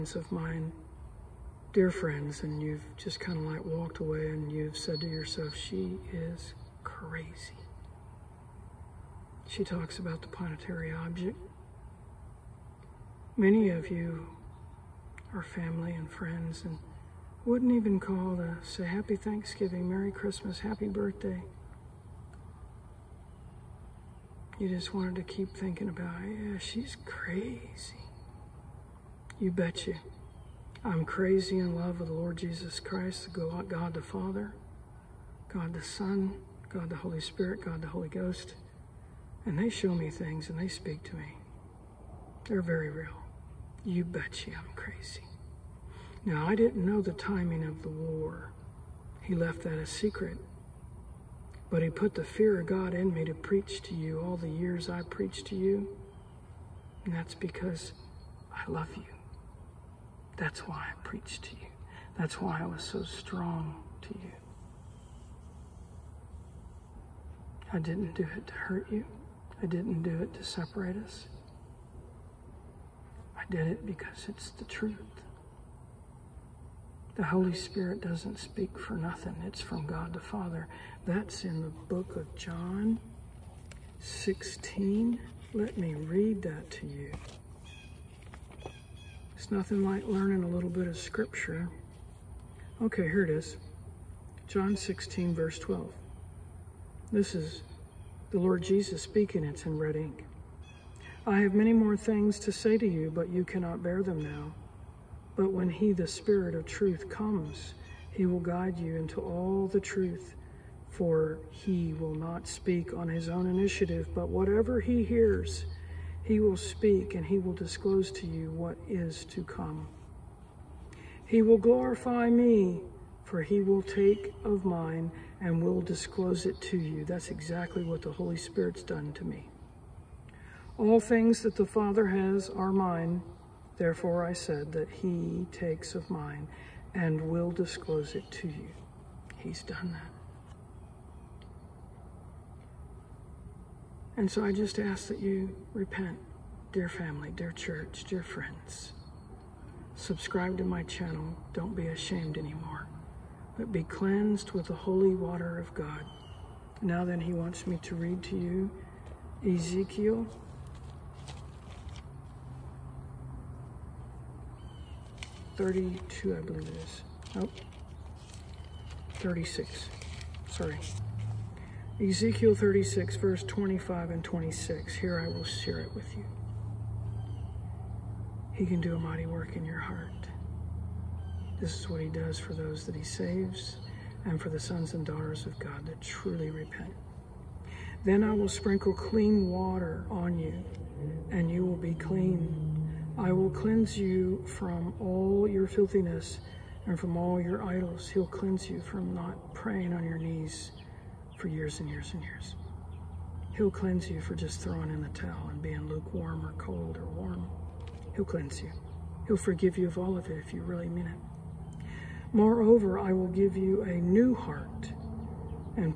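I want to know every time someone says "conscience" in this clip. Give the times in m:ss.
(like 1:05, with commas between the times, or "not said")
not said.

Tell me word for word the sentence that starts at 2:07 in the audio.
That's exactly what the Holy Spirit's done to me.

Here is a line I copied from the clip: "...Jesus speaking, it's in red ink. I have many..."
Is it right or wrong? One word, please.
right.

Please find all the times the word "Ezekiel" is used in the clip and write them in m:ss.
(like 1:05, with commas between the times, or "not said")
2:39, 2:52.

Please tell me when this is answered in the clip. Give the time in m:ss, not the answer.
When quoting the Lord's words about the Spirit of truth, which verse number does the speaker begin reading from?
1:35.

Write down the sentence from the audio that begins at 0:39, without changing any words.
And they show me things and they speak to me.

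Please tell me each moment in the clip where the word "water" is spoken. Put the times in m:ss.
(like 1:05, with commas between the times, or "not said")
2:35, 3:09.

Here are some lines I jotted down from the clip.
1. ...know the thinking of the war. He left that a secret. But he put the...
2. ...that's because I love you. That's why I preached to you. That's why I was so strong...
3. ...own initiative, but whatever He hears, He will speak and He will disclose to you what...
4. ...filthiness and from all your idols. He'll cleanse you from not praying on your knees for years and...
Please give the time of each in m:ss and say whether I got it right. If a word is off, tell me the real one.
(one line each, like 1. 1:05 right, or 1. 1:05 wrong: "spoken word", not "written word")
1. 0:46 wrong: "timing", not "thinking"
2. 0:57 right
3. 1:53 right
4. 3:15 right.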